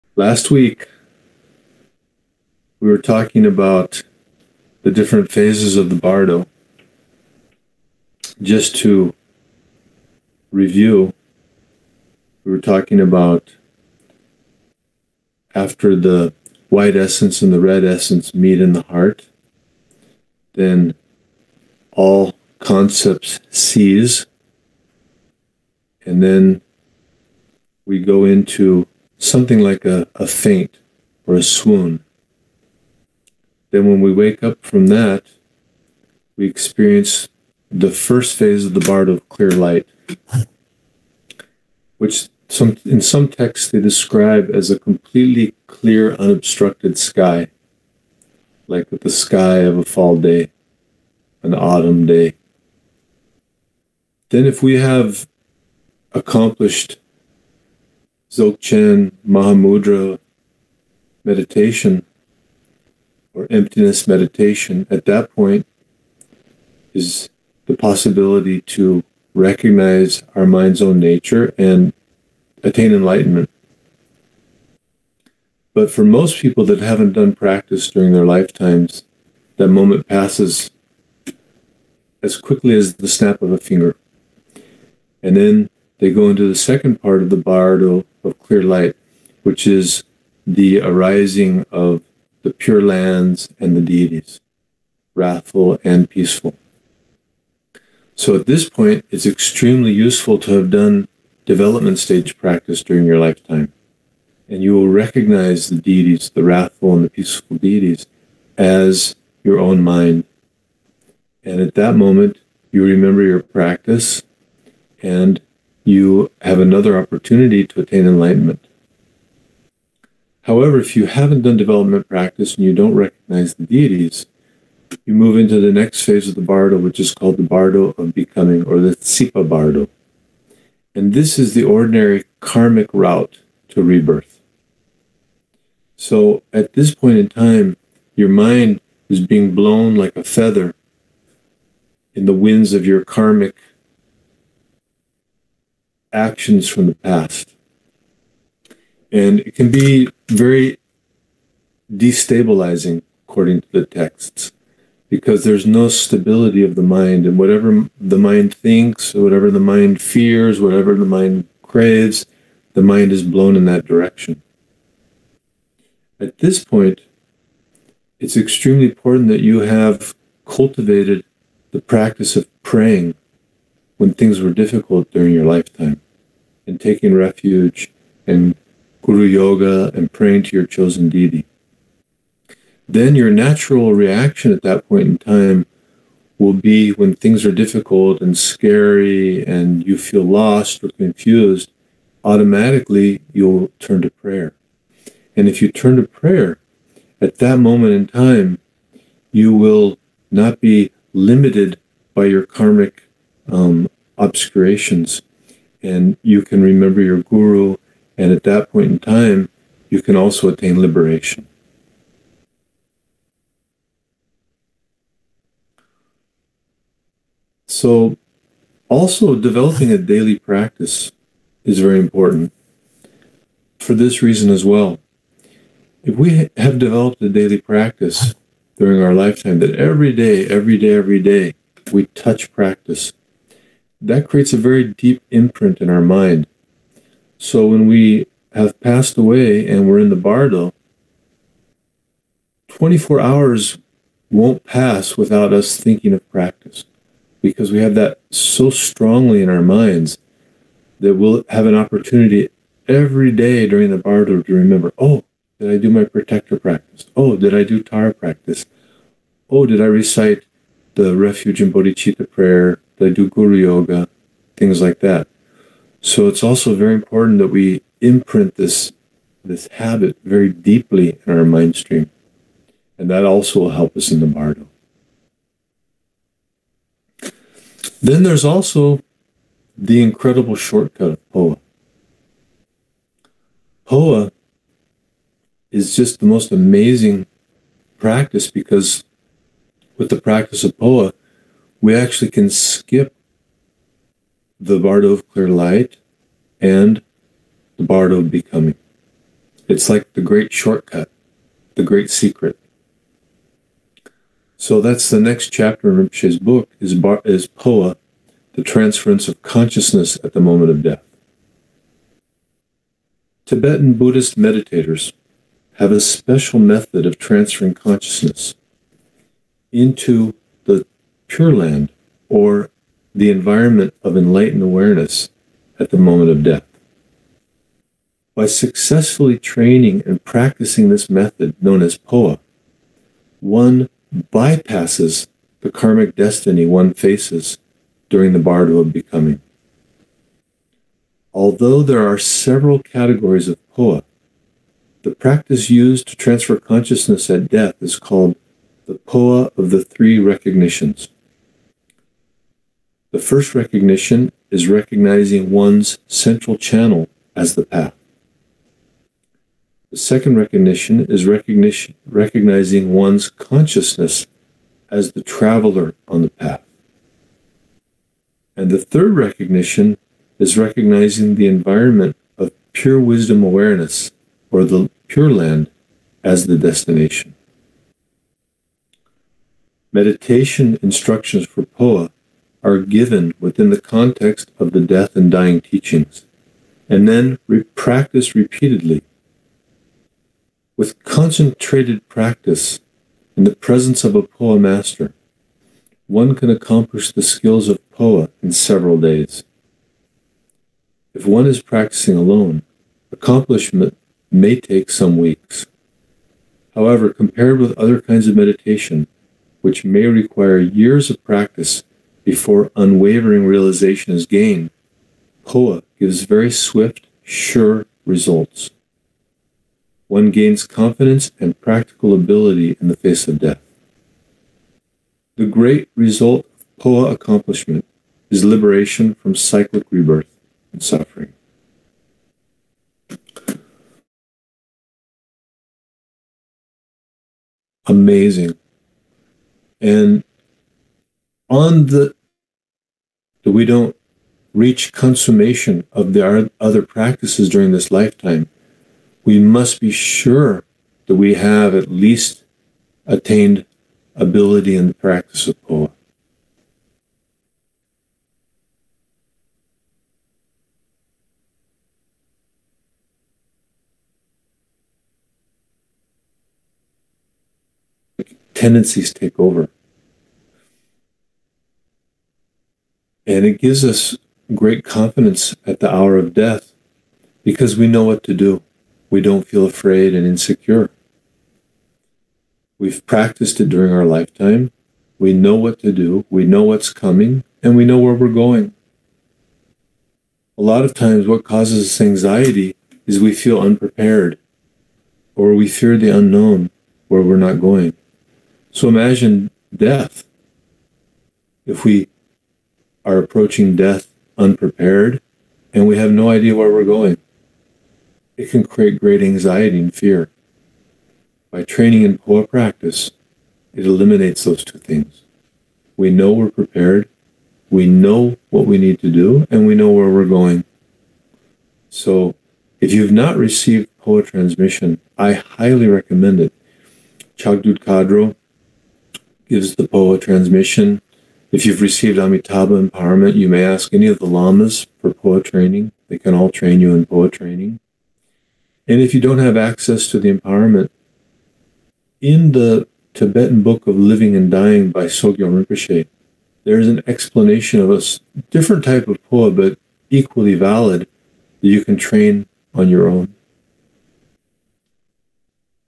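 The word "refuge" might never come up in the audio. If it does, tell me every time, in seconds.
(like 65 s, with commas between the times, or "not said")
177 s, 261 s.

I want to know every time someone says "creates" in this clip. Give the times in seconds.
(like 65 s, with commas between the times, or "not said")
234 s, 508 s.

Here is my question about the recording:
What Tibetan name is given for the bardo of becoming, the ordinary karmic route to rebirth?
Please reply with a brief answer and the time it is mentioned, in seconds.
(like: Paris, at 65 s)
Sipa bardo, at 128 s.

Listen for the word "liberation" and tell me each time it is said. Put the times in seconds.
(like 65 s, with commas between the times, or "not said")
210 s, 428 s.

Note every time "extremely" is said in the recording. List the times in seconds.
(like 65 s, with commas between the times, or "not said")
99 s, 168 s.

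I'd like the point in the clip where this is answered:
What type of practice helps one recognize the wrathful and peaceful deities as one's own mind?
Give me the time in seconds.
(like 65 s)
101 s.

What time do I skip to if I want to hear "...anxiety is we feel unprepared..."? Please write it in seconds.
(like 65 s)
492 s.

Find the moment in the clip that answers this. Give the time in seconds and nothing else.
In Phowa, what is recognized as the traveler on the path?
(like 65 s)
362 s.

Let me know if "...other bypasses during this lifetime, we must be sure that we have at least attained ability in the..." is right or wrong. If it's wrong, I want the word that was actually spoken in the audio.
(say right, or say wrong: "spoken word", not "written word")
wrong: "practices", not "bypasses".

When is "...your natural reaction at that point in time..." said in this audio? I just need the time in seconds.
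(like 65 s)
183 s.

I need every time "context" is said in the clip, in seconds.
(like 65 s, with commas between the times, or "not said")
383 s.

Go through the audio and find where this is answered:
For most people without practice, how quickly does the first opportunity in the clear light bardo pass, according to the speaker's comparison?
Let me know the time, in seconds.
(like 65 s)
83 s.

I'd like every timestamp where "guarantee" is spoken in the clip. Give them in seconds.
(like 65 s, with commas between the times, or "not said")
not said.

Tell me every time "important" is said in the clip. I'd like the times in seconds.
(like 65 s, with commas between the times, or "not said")
168 s, 221 s, 266 s.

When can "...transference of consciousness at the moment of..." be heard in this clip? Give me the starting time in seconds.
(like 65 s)
308 s.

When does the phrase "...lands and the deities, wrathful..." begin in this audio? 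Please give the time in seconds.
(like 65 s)
92 s.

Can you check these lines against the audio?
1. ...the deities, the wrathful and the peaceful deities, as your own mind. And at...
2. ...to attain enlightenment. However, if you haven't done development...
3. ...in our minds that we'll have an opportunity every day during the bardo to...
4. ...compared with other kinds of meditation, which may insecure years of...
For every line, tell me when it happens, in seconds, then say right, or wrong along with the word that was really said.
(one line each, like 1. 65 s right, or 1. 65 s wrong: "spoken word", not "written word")
1. 105 s right
2. 117 s right
3. 249 s right
4. 407 s wrong: "require", not "insecure".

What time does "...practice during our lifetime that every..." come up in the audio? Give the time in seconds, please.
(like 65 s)
227 s.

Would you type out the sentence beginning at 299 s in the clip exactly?
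It's like the great shortcut, the great secret.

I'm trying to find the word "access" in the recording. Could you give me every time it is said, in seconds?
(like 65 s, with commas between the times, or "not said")
539 s.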